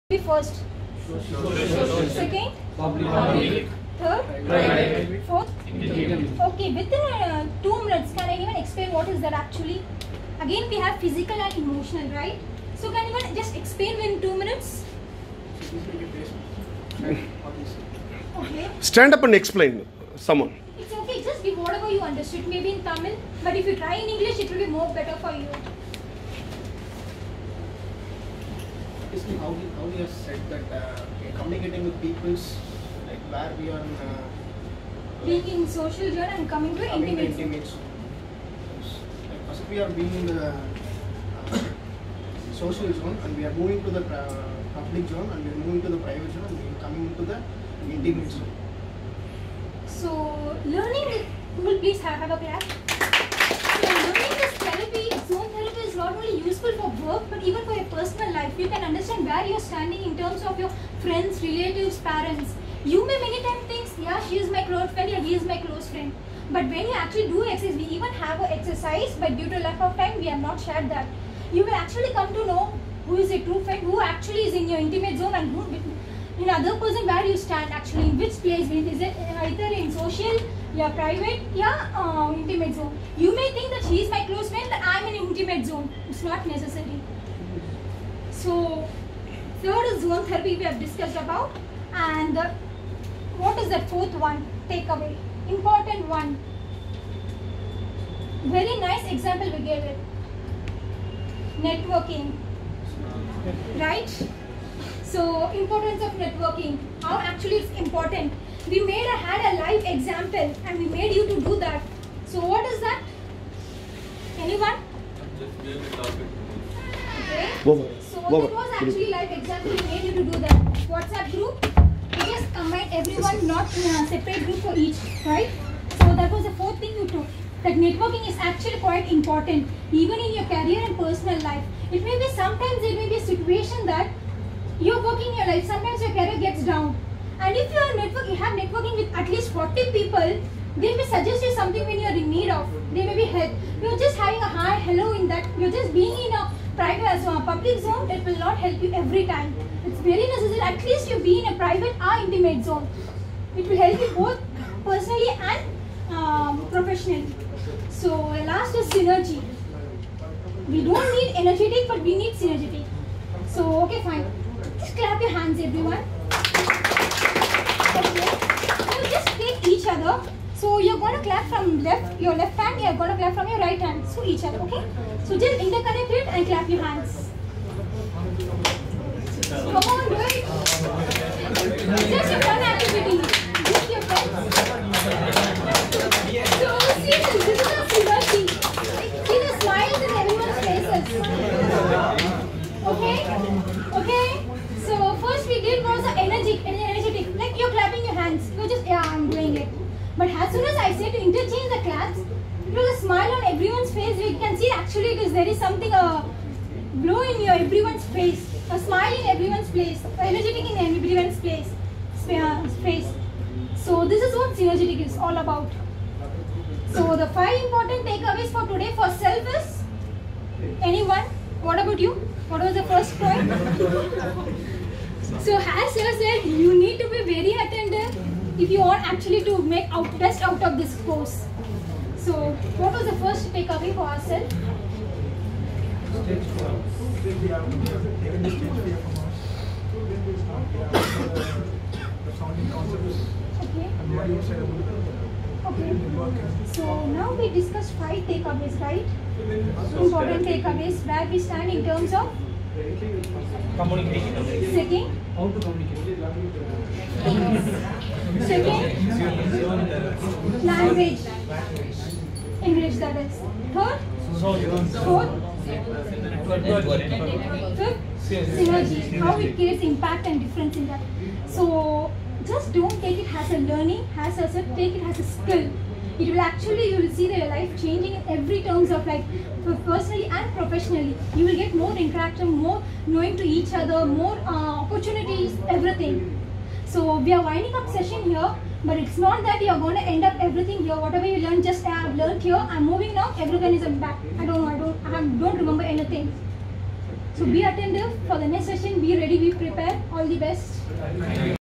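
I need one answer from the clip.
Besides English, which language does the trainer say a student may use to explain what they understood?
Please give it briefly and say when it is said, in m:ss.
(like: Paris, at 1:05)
Tamil, at 0:22.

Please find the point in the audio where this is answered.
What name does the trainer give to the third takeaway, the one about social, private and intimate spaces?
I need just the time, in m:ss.
1:30.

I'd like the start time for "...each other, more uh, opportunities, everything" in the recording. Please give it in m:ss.
4:43.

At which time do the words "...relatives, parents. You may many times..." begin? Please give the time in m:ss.
1:01.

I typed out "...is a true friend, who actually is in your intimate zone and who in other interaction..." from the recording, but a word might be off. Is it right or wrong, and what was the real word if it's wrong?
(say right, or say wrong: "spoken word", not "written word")
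wrong: "person", not "interaction".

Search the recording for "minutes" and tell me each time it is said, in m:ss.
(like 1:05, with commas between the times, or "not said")
0:07, 0:14.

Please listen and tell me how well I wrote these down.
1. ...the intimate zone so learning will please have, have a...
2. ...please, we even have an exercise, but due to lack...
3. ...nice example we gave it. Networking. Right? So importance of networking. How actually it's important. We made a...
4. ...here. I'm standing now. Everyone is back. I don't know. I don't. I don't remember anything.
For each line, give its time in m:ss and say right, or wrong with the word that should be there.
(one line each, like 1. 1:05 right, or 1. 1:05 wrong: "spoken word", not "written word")
1. 0:47 right
2. 1:07 wrong: "exercise", not "please"
3. 1:38 right
4. 4:52 wrong: "moving", not "standing".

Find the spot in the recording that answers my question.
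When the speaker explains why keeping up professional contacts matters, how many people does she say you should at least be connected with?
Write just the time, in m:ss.
2:19.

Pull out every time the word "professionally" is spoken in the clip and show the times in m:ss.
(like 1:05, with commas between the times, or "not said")
2:36, 4:40.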